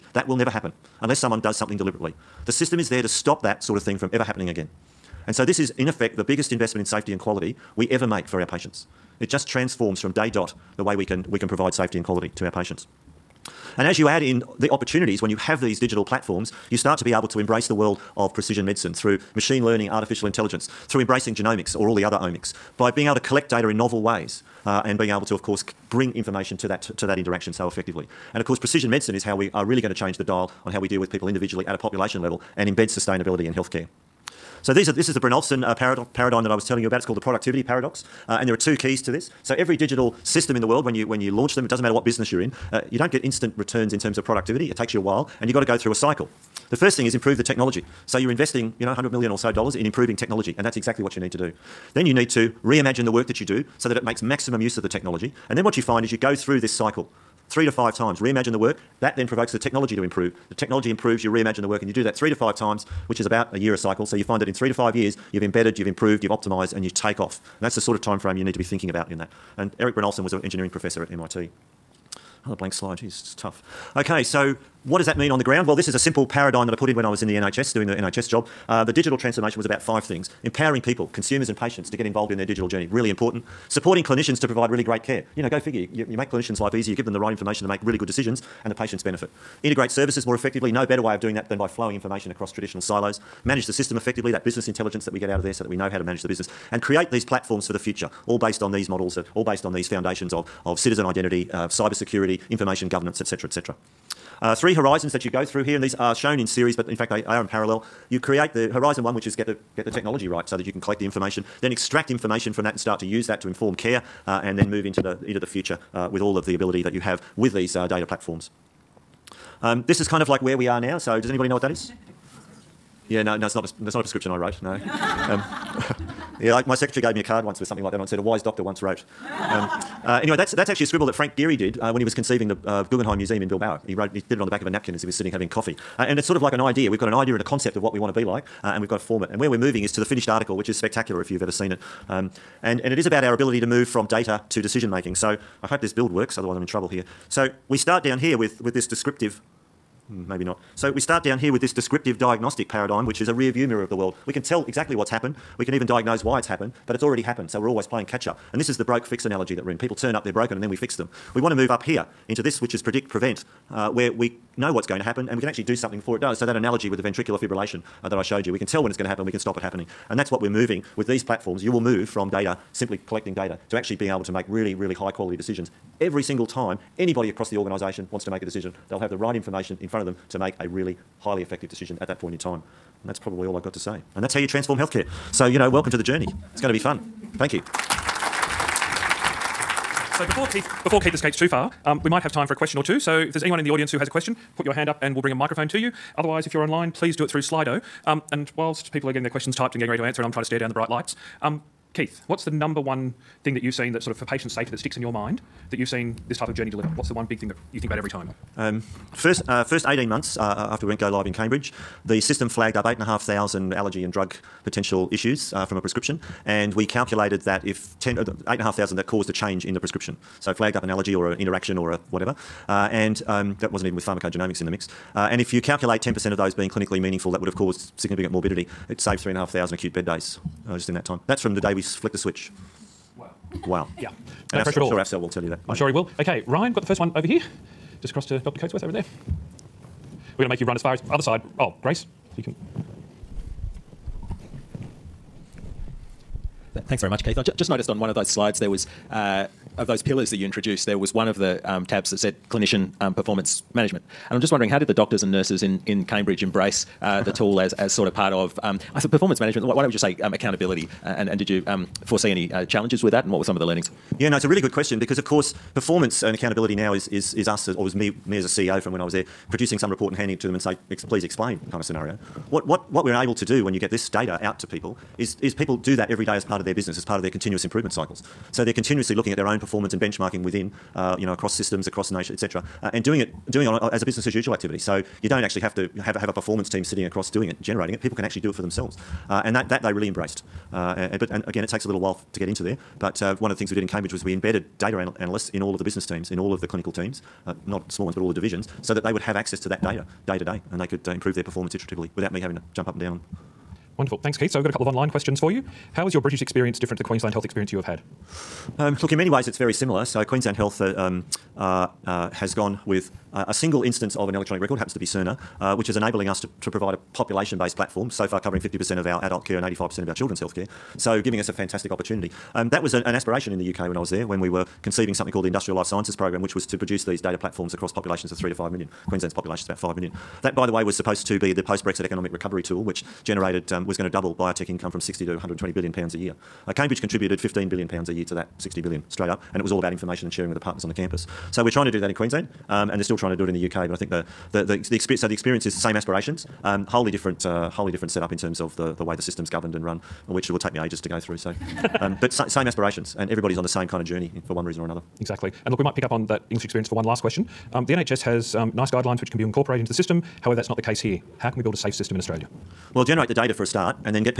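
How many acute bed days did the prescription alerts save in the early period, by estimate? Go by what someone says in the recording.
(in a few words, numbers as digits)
3,500.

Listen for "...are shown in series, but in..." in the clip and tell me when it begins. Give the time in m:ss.
1:45.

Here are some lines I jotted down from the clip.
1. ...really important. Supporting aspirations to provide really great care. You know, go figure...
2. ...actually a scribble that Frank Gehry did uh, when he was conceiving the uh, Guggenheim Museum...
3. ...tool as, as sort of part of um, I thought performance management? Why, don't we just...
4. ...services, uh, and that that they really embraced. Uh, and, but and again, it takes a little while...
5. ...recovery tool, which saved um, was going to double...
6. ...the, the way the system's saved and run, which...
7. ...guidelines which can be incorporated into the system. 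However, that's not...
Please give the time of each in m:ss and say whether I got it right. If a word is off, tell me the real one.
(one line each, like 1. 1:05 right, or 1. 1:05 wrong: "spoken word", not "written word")
1. 1:22 wrong: "clinicians", not "aspirations"
2. 2:10 right
3. 4:17 right
4. 4:48 wrong: "themselves", not "services"
5. 5:32 wrong: "generated", not "saved"
6. 5:48 wrong: "governed", not "saved"
7. 5:58 right.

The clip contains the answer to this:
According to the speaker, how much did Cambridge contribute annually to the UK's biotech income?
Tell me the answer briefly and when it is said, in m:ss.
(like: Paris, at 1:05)
15 billion pounds, at 5:37.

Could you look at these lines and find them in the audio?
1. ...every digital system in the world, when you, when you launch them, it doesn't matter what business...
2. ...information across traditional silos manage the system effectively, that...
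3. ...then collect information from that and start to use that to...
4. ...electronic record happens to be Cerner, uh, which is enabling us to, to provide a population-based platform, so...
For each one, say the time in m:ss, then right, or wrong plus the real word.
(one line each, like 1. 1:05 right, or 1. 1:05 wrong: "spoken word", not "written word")
1. 0:39 right
2. 1:31 right
3. 1:51 wrong: "extract", not "collect"
4. 5:14 right.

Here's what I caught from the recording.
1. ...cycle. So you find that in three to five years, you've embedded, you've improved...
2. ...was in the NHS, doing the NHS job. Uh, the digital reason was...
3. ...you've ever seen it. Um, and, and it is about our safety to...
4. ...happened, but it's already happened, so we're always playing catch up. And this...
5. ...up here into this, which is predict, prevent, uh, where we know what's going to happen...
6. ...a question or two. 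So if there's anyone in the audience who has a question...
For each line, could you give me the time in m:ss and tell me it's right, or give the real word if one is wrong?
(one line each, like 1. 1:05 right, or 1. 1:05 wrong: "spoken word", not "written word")
1. 1:03 right
2. 1:17 wrong: "transformation", not "reason"
3. 2:21 wrong: "ability", not "safety"
4. 2:36 right
5. 2:41 right
6. 3:12 right.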